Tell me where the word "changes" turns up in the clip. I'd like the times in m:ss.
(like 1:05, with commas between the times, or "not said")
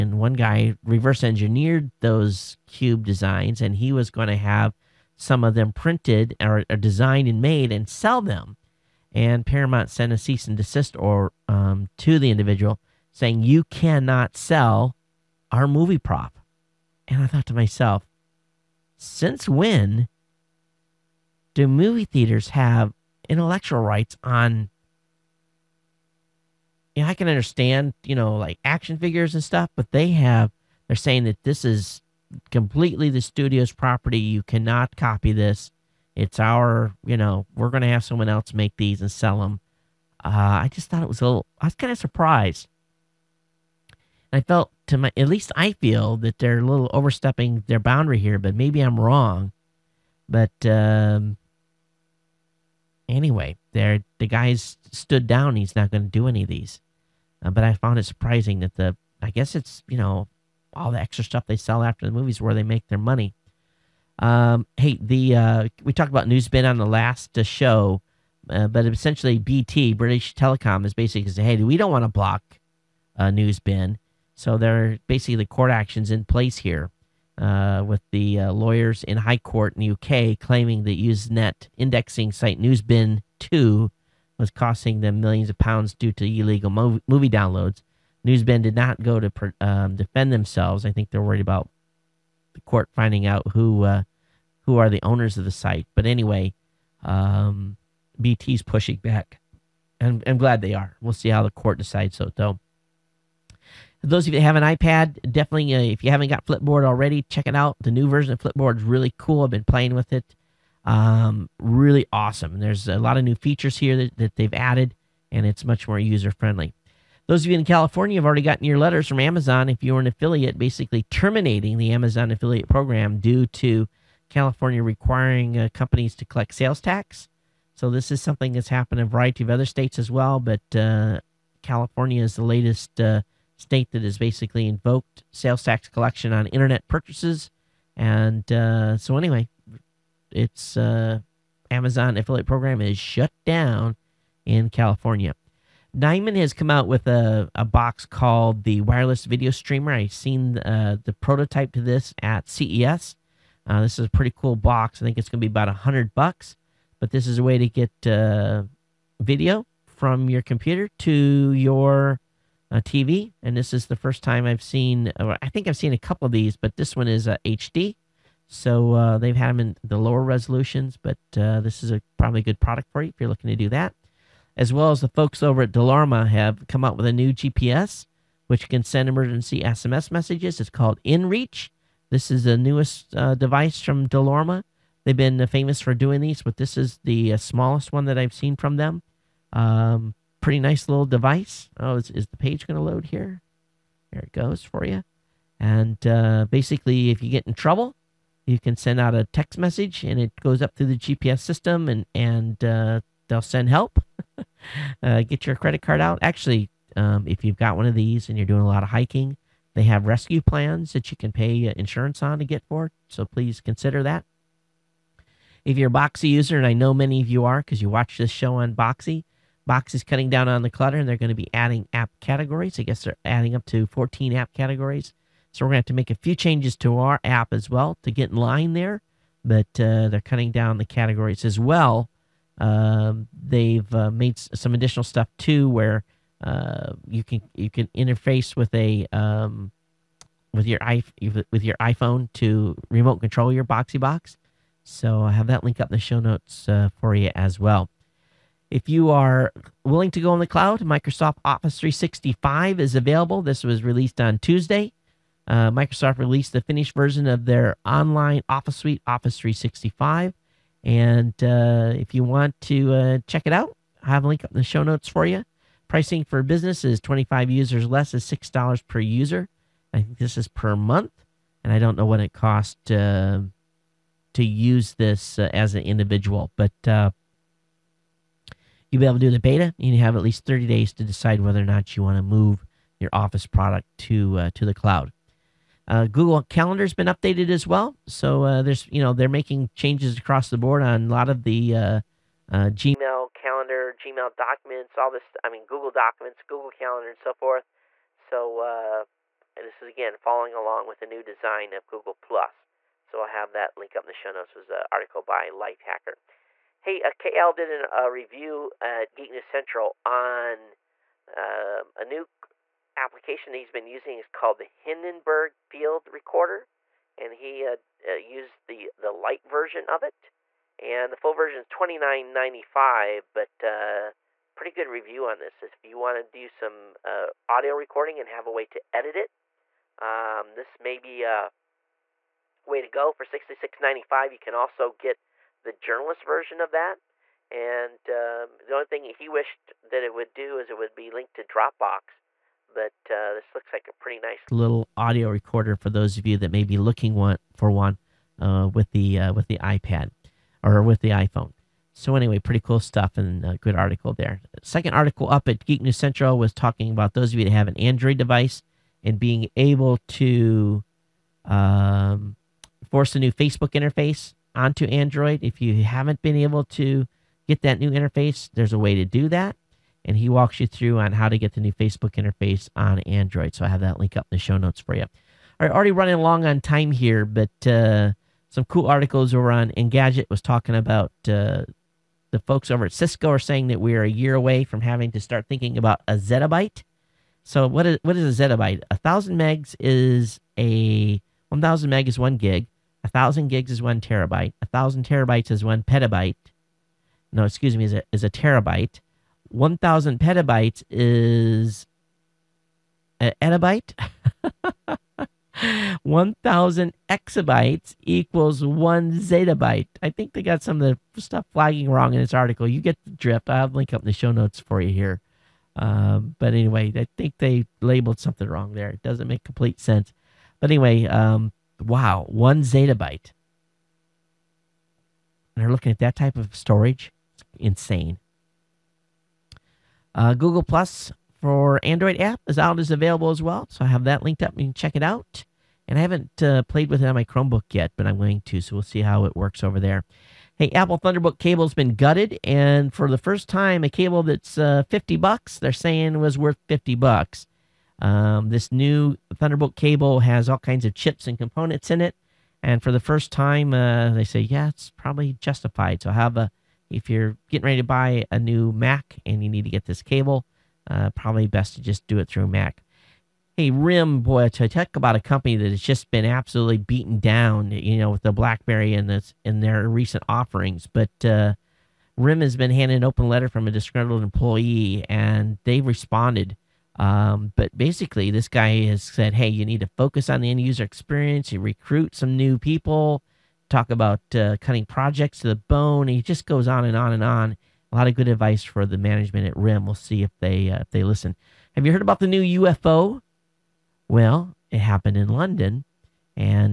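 3:46, 4:49.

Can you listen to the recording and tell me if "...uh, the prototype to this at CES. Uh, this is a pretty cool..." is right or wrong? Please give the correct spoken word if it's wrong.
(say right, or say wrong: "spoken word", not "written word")
right.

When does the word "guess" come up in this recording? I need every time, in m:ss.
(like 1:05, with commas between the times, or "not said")
0:59, 3:42.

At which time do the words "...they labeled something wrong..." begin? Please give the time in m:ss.
6:57.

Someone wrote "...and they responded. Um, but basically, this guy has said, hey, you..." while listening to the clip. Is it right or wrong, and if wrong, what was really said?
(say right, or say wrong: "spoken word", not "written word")
right.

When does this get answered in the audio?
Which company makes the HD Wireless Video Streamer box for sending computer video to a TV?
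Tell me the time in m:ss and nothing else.
2:25.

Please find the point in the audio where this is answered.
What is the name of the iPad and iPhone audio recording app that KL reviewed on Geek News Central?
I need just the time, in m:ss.
5:14.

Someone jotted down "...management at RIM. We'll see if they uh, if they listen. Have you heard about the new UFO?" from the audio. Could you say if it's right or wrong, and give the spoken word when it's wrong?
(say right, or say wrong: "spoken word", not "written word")
right.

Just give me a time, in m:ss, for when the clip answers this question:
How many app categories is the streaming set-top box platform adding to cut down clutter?
3:43.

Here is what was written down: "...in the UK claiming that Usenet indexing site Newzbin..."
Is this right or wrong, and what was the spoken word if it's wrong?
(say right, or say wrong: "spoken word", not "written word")
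right.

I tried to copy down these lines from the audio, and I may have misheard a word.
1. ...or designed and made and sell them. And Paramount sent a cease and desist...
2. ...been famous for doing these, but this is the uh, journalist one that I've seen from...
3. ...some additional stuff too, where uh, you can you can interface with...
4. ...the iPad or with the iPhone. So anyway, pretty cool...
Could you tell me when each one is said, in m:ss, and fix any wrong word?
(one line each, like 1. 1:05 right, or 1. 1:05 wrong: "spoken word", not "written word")
1. 0:06 right
2. 3:05 wrong: "smallest", not "journalist"
3. 3:54 right
4. 5:49 right.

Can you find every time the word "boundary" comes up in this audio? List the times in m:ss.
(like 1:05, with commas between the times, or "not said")
0:47.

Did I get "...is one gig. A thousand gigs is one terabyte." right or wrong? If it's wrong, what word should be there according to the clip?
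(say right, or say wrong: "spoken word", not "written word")
right.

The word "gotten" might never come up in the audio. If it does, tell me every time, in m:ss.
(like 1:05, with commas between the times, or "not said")
1:58.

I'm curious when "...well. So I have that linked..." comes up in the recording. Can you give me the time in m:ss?
7:13.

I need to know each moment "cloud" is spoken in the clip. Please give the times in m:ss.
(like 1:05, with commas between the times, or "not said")
4:10, 4:44.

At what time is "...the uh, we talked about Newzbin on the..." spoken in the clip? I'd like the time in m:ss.
1:04.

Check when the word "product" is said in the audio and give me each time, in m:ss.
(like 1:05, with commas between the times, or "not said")
2:52, 4:43.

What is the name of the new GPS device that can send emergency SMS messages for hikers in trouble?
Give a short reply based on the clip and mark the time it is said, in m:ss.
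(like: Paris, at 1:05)
InReach, at 3:01.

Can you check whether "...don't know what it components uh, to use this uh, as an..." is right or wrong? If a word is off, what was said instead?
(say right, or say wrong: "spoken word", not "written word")
wrong: "costs", not "components".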